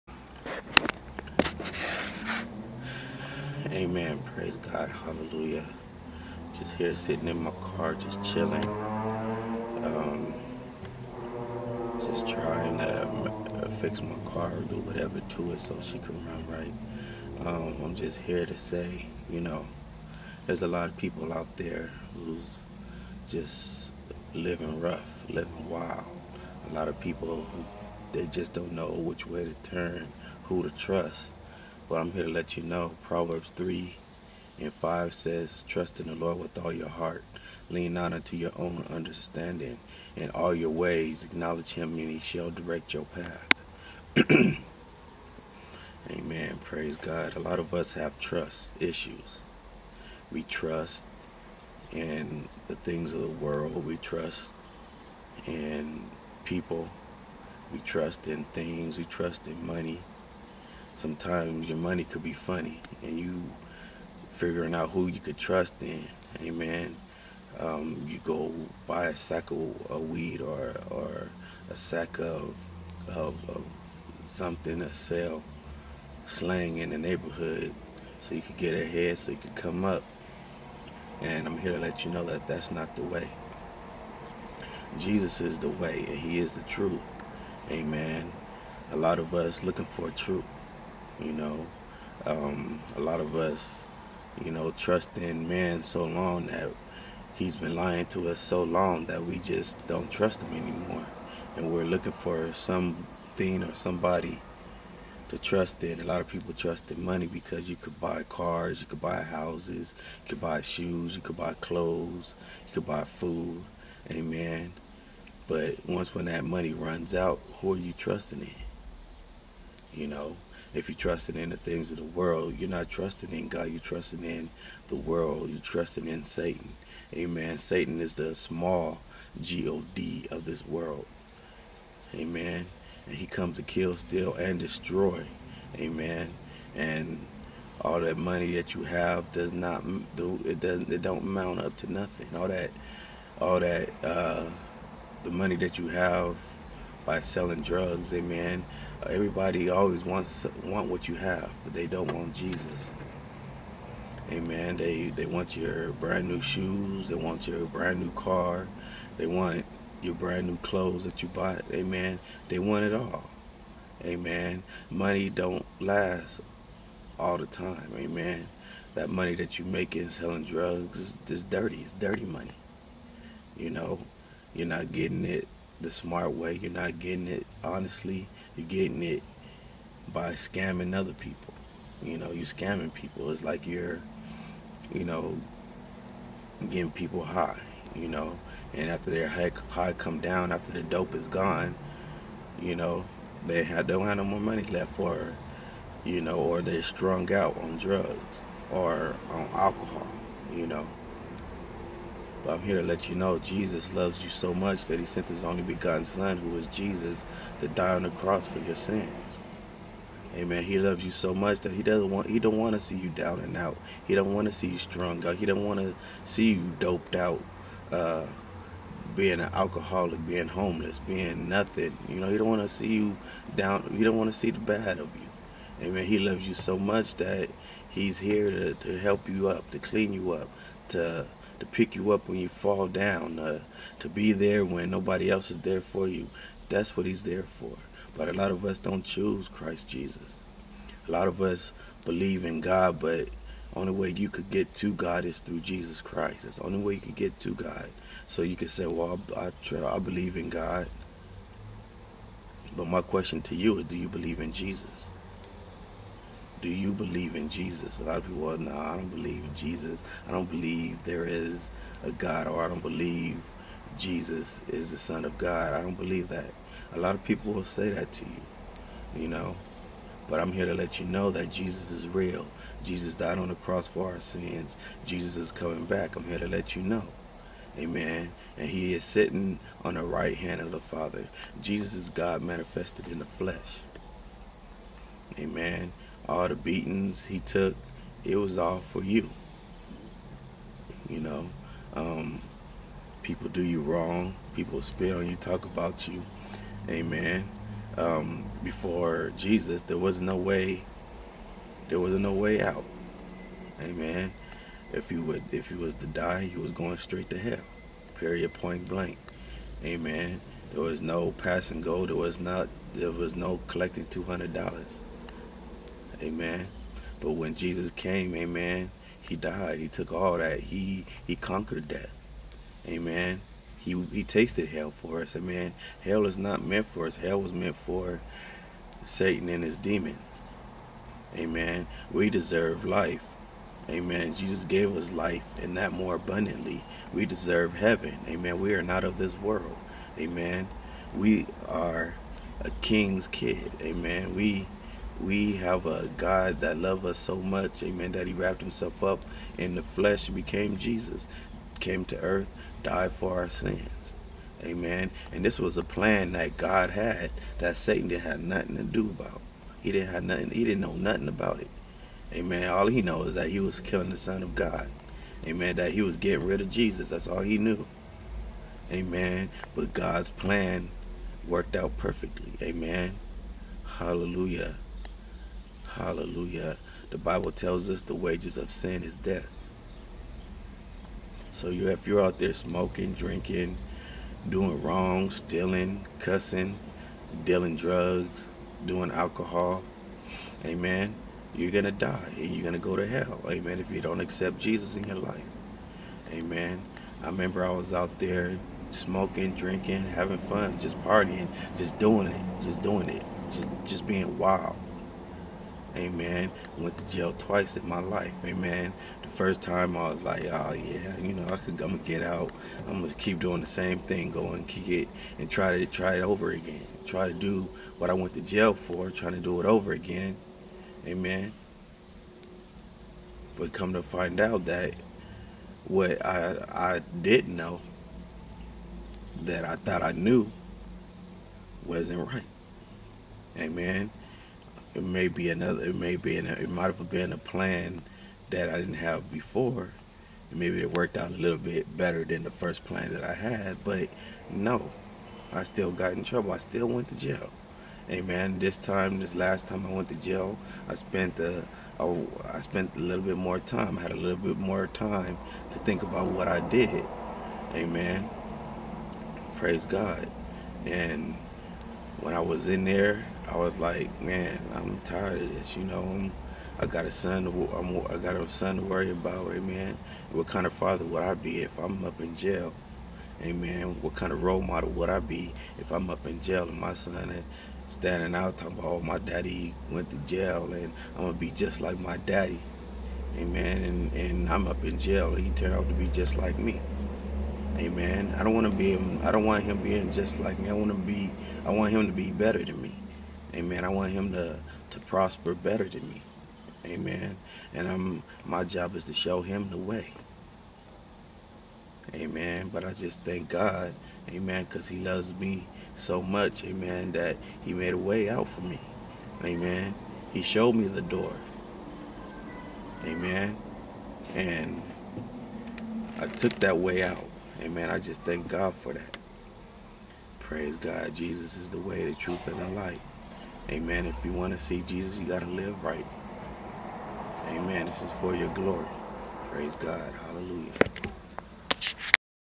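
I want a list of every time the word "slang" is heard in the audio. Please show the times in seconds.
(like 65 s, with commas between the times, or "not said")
76 s.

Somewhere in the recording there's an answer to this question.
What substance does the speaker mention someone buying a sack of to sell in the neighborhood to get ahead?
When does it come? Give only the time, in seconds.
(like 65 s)
70 s.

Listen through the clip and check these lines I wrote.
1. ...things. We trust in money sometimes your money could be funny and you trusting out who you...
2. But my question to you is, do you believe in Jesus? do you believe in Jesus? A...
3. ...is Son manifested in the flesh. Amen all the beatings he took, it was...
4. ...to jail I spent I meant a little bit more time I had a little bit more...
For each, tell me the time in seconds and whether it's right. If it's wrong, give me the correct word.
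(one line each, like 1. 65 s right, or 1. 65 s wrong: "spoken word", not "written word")
1. 58 s wrong: "figuring", not "trusting"
2. 252 s right
3. 281 s wrong: "God", not "Son"
4. 450 s wrong: "spent", not "meant".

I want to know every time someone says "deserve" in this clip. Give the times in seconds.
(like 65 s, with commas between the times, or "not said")
332 s, 337 s.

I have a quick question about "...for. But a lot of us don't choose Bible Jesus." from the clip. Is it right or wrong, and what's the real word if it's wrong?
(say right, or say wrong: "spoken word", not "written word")
wrong: "Christ", not "Bible".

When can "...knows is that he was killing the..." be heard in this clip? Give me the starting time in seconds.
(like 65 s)
363 s.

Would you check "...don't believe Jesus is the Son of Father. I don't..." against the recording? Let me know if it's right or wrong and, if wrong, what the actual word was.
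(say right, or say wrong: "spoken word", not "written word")
wrong: "God", not "Father".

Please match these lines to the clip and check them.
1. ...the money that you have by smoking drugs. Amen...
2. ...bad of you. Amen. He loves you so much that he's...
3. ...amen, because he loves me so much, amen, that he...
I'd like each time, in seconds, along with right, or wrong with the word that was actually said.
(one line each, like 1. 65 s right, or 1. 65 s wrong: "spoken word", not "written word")
1. 145 s wrong: "selling", not "smoking"
2. 224 s right
3. 504 s right.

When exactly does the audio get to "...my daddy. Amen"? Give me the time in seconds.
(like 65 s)
481 s.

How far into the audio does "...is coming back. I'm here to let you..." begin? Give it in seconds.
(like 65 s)
275 s.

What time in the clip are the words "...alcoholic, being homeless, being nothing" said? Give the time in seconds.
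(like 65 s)
219 s.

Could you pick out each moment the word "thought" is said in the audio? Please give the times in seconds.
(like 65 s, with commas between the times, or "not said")
429 s.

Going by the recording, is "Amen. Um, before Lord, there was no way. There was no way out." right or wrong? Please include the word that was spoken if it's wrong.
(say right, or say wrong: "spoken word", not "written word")
wrong: "Jesus", not "Lord".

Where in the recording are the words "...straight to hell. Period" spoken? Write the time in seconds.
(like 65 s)
306 s.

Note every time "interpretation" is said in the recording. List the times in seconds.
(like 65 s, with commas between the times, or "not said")
not said.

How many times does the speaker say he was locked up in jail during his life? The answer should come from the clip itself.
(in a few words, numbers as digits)
Twice.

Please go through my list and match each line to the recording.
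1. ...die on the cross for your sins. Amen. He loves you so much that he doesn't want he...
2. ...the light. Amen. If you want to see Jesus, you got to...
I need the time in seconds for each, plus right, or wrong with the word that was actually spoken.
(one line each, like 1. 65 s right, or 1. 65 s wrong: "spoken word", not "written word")
1. 207 s right
2. 522 s right.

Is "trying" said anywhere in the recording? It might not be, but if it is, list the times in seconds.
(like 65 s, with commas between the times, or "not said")
12 s, 419 s.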